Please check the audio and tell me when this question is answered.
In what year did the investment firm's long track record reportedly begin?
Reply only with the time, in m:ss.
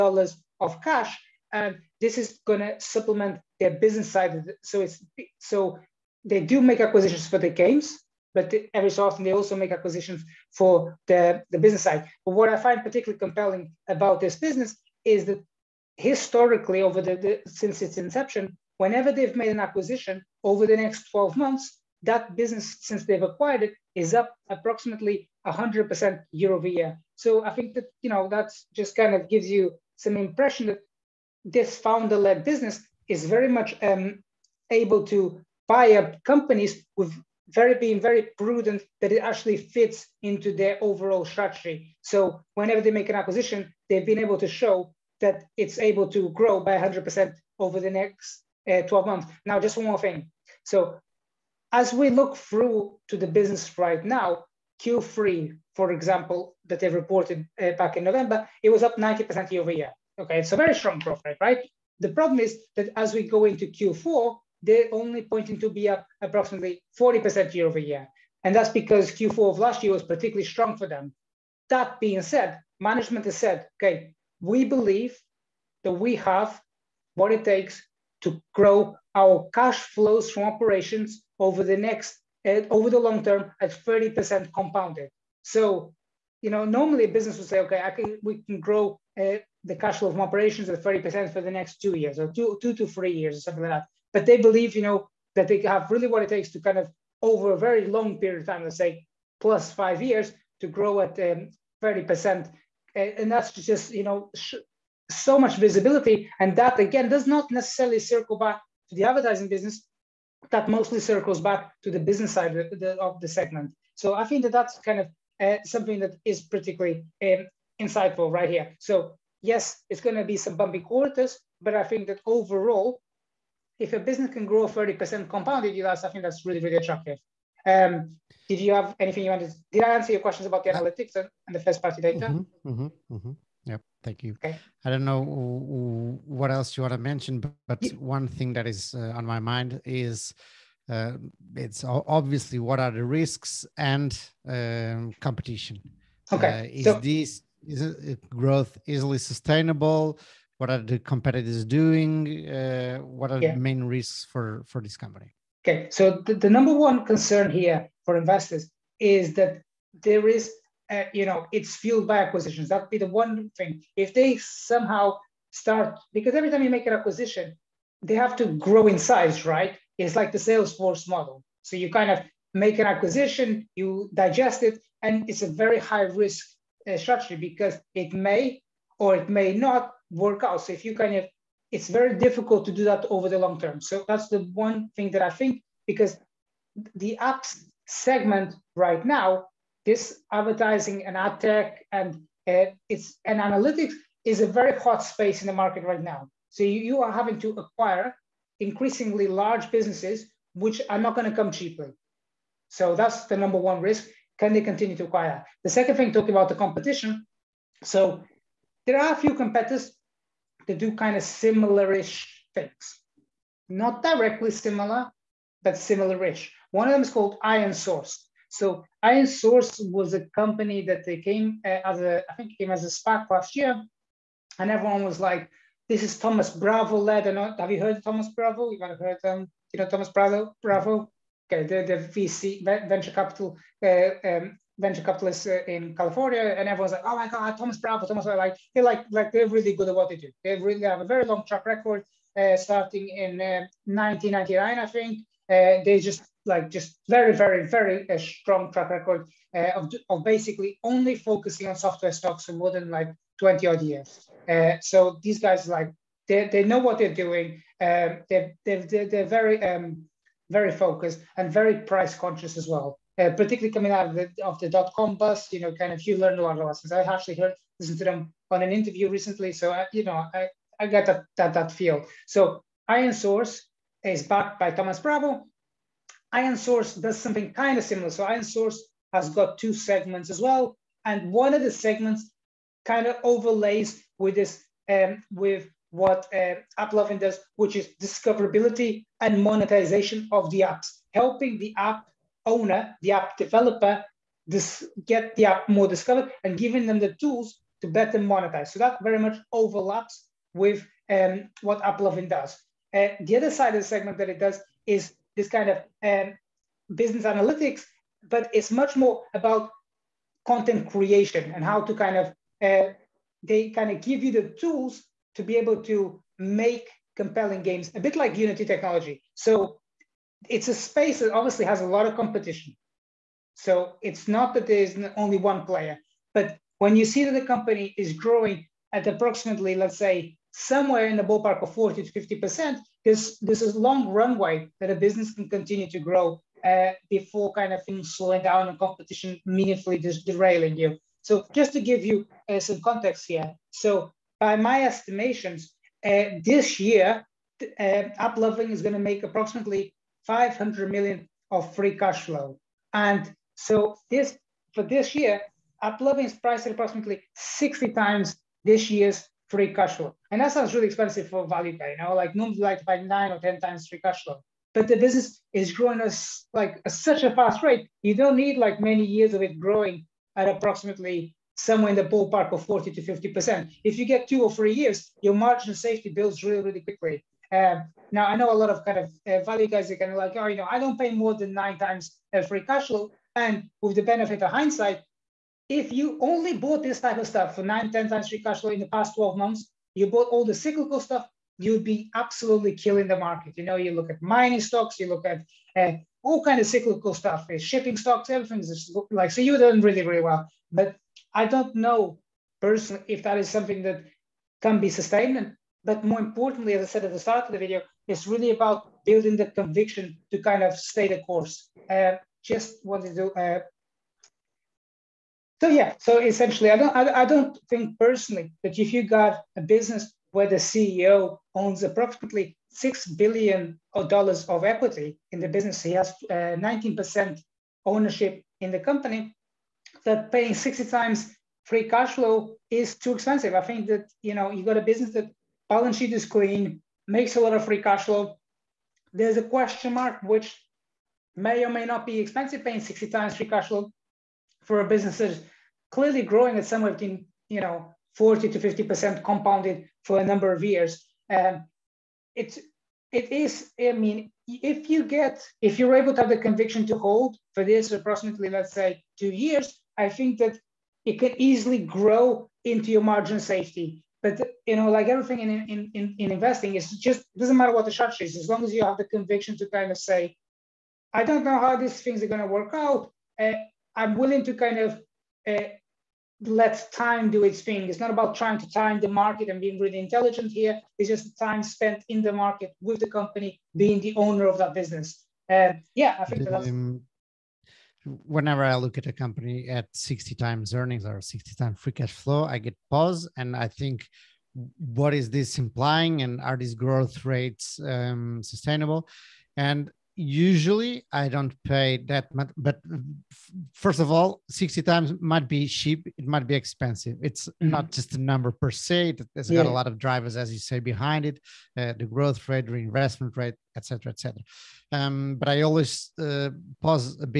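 4:03.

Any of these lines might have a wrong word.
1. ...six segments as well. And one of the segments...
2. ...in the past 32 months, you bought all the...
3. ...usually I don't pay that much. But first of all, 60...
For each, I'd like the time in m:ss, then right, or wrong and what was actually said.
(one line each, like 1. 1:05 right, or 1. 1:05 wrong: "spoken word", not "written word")
1. 4:39 wrong: "two", not "six"
2. 6:28 wrong: "12", not "32"
3. 8:20 right.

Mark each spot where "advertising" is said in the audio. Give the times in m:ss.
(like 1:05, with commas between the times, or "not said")
1:49, 3:10.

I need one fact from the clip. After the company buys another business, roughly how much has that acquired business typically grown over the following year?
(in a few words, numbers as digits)
100%.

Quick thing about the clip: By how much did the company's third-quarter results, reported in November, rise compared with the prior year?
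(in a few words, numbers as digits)
90%.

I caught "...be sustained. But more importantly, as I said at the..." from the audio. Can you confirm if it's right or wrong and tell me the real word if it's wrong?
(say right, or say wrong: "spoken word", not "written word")
right.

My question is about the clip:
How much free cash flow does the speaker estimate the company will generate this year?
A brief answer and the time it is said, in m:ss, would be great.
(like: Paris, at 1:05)
500 million, at 5:50.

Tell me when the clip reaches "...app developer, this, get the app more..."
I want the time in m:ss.
4:53.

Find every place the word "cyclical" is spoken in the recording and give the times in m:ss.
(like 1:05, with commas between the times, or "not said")
6:30, 6:36.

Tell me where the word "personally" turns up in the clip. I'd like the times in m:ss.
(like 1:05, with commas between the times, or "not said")
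6:42, 6:57.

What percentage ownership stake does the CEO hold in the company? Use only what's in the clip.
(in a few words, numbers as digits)
19%.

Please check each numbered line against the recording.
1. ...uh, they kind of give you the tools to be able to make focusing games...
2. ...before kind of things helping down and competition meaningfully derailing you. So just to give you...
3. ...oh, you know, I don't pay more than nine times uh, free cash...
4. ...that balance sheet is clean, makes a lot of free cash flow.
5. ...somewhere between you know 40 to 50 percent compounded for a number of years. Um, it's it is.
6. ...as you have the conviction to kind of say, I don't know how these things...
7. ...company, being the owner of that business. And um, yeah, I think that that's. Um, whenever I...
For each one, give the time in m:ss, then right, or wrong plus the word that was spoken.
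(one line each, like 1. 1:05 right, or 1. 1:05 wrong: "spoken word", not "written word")
1. 5:12 wrong: "compelling", not "focusing"
2. 5:37 wrong: "slowing", not "helping"
3. 6:20 right
4. 7:15 right
5. 7:26 right
6. 7:48 right
7. 8:03 right.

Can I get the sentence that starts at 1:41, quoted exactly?
Um, eh, and that's just, you know, so much visibility.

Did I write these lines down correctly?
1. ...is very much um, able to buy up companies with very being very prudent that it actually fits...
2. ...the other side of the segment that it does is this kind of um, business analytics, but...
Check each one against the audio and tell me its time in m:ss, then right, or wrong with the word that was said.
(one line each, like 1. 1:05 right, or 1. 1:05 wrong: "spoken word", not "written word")
1. 0:33 right
2. 5:03 right.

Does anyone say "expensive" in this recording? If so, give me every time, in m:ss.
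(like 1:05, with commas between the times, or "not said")
6:00, 7:13, 7:22, 8:26.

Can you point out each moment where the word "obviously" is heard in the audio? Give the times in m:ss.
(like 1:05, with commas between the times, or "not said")
2:21, 5:21.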